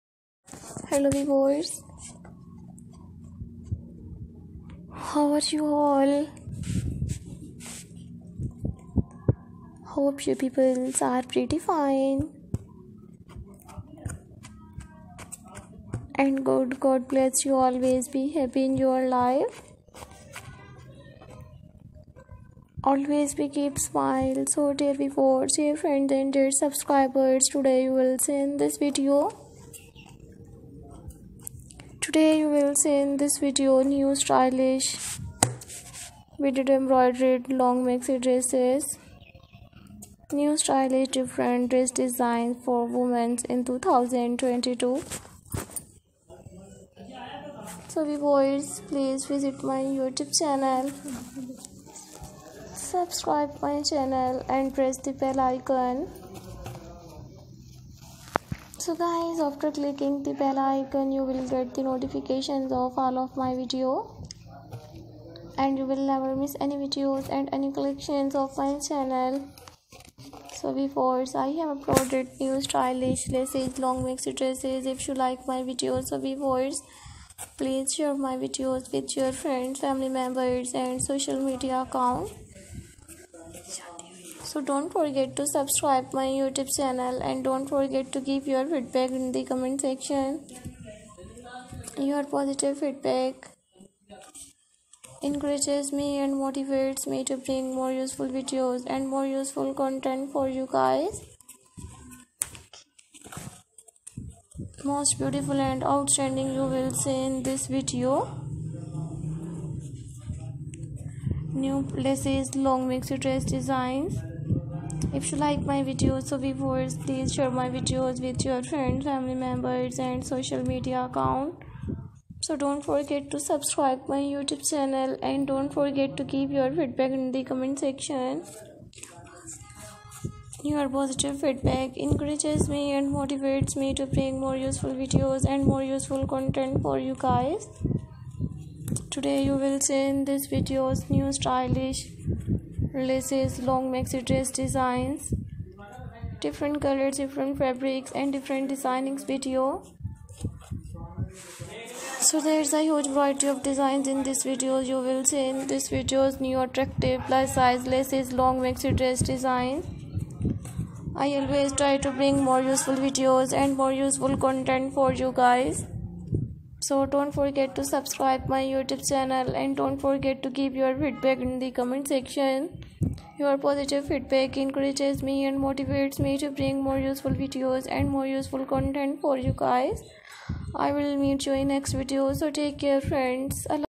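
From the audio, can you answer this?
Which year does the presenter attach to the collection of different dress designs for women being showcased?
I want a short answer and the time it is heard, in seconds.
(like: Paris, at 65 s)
2022, at 43 s.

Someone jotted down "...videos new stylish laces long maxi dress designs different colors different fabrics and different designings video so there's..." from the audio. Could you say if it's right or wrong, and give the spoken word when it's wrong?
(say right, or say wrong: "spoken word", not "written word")
right.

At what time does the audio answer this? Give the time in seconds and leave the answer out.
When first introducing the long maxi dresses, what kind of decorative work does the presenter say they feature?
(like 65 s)
36 s.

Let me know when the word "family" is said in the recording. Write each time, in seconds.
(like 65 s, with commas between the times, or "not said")
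79 s, 119 s.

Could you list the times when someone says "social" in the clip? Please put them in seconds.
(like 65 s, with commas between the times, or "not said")
81 s, 120 s.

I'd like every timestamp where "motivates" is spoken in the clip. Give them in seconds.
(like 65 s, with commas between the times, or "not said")
96 s, 133 s, 175 s.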